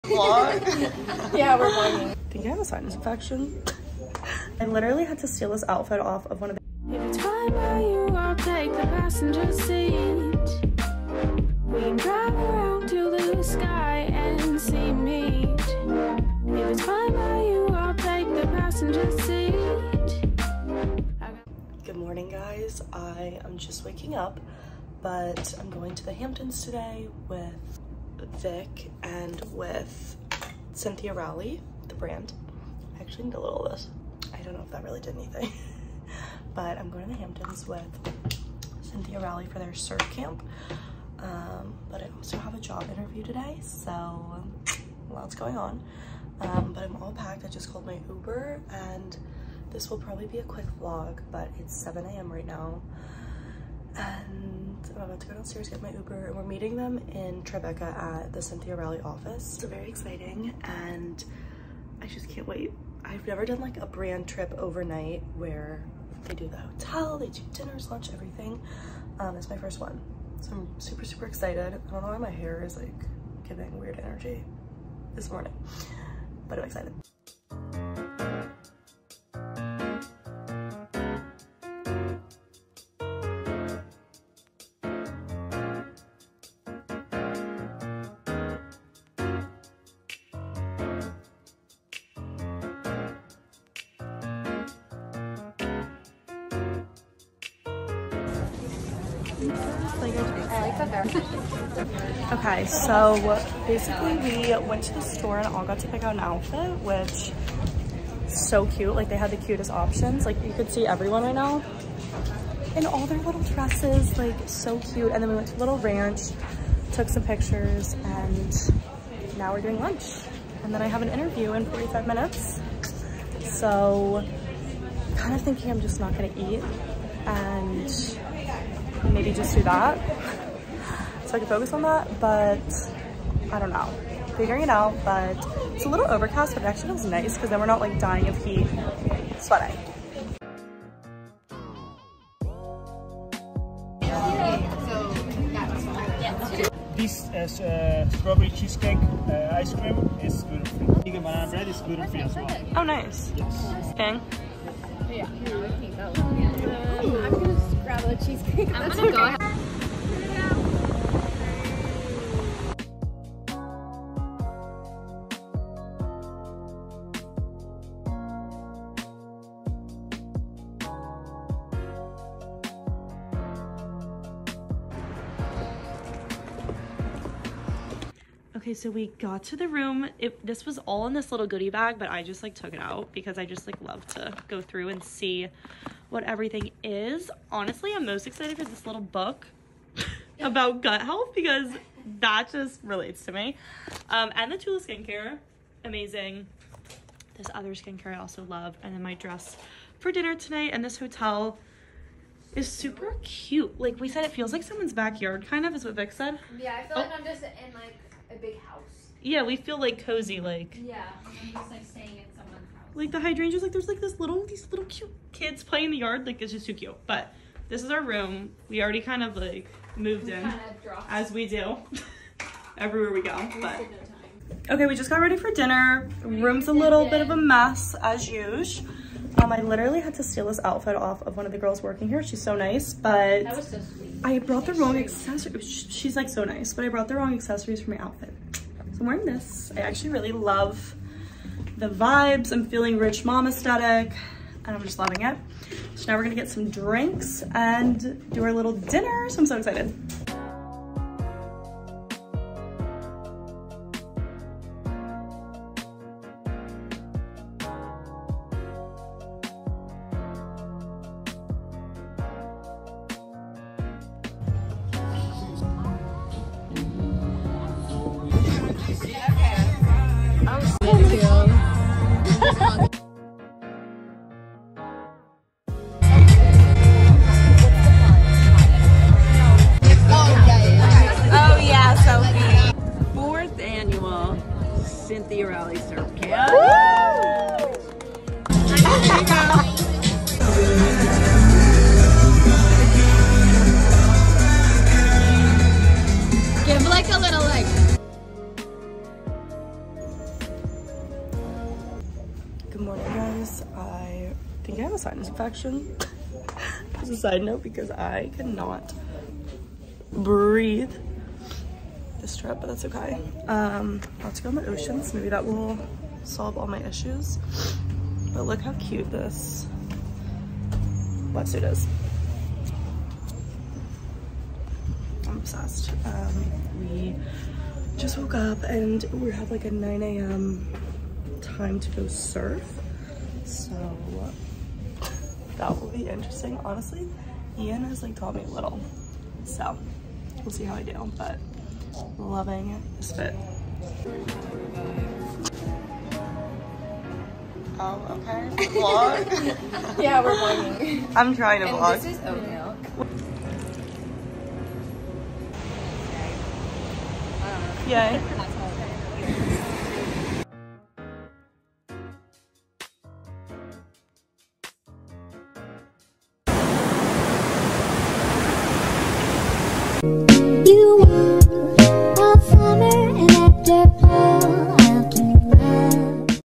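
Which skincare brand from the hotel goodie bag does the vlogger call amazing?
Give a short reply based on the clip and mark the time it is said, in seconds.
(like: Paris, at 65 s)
Tula, at 194 s.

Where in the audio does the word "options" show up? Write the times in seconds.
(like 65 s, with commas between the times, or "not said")
109 s.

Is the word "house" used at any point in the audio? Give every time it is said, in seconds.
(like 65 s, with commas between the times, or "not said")
208 s, 212 s.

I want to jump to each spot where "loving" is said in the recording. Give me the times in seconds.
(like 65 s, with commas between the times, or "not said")
244 s, 342 s.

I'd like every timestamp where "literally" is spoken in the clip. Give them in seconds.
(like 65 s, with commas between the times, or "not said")
4 s, 229 s.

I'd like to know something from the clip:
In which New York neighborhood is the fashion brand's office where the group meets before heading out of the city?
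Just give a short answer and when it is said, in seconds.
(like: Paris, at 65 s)
Tribeca, at 57 s.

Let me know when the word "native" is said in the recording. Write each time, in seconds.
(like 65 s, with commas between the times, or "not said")
not said.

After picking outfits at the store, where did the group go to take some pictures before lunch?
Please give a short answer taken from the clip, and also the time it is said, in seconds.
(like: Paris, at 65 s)
Little Ranch, at 115 s.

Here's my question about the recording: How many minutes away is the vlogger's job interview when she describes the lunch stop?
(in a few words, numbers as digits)
45.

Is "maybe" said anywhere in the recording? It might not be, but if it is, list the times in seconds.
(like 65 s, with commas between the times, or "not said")
129 s, 315 s.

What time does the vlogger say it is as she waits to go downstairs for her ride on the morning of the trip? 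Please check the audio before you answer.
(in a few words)
7 a.m.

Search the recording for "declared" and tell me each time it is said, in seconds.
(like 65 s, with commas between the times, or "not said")
not said.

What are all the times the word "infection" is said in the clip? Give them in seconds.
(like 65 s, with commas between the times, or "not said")
2 s, 305 s.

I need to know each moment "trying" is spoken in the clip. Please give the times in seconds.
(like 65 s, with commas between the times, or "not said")
351 s.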